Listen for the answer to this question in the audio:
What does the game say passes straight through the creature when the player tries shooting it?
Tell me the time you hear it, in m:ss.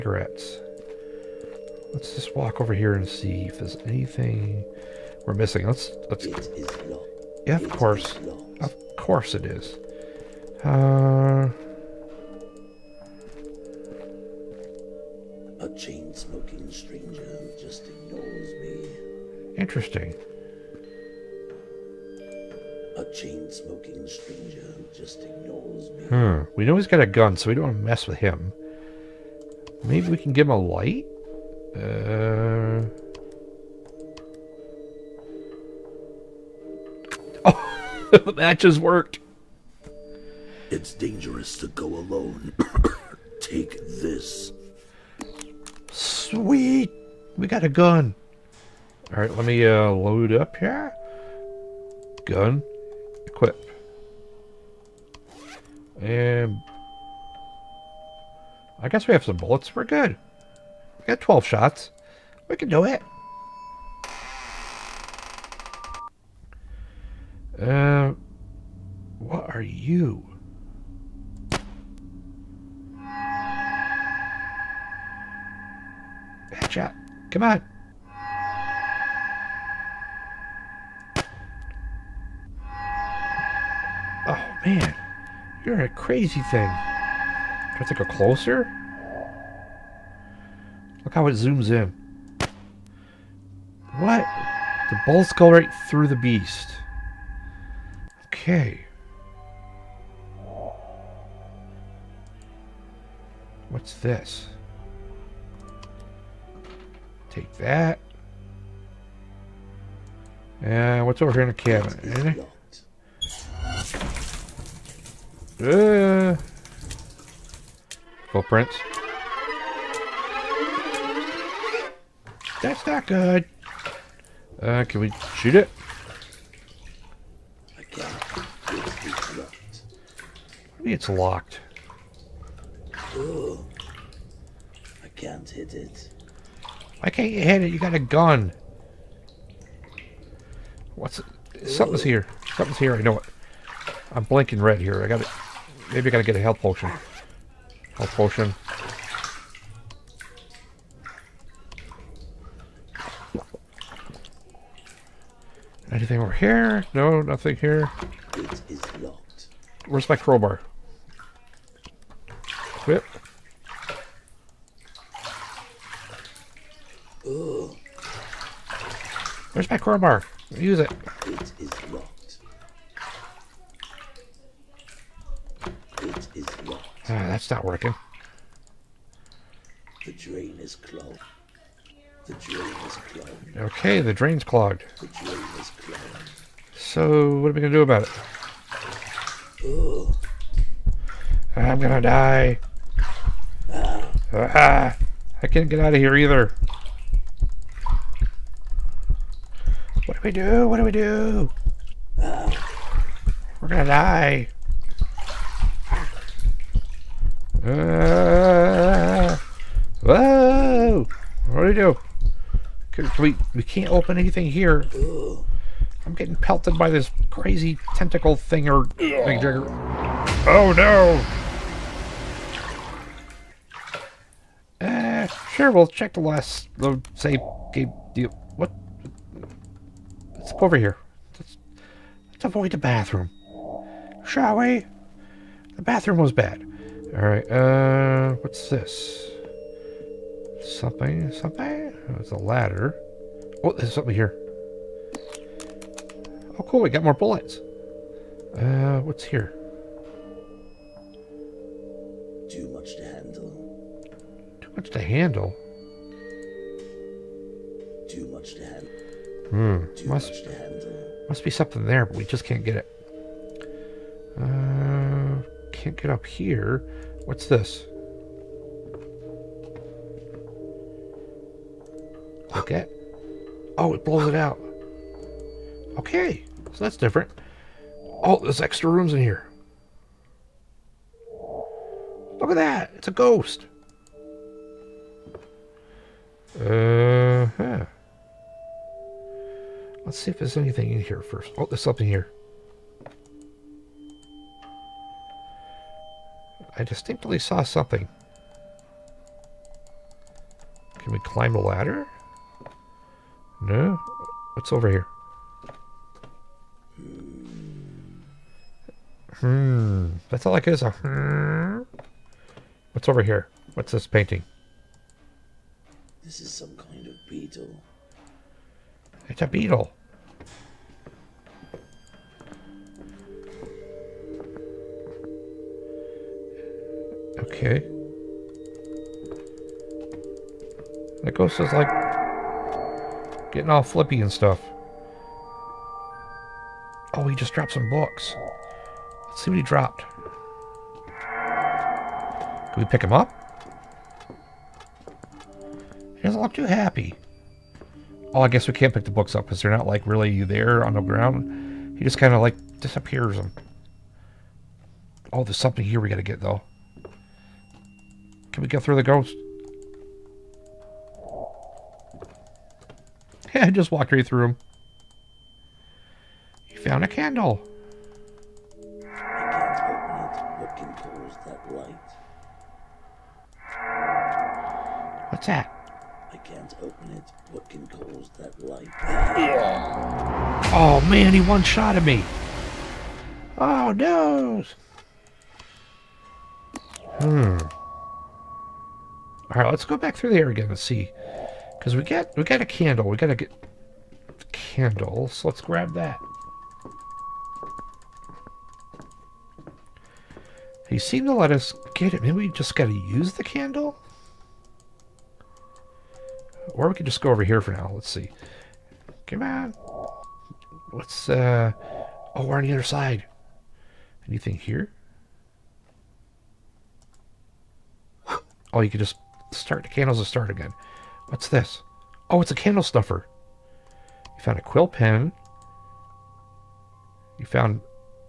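1:34.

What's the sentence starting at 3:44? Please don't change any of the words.
Uh, sure, we'll check the last, the save game deal.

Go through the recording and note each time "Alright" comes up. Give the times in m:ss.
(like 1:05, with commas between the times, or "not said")
3:57.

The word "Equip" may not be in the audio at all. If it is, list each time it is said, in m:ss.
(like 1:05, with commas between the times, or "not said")
0:53.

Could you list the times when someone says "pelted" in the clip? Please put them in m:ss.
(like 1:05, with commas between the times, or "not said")
3:36.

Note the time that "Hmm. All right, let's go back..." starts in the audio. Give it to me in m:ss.
6:27.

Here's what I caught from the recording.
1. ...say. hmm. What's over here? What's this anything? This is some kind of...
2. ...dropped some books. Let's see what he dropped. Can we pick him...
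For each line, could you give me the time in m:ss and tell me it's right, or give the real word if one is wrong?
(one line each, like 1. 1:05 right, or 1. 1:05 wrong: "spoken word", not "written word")
1. 5:10 wrong: "painting", not "anything"
2. 5:37 right.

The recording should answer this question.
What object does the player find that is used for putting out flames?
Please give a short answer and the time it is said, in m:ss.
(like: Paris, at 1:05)
Candle snuffer, at 7:02.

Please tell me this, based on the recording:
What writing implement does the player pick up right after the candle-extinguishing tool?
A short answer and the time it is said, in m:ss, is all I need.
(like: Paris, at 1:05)
Quill pen, at 7:04.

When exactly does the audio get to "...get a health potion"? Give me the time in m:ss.
2:26.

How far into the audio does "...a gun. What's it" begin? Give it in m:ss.
2:17.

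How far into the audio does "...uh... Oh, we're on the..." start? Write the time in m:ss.
6:51.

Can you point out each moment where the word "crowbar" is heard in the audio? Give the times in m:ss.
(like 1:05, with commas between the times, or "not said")
2:40, 2:49.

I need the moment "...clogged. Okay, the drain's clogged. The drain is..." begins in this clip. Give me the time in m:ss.
3:02.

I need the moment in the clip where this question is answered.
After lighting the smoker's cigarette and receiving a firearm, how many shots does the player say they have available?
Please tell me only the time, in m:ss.
1:01.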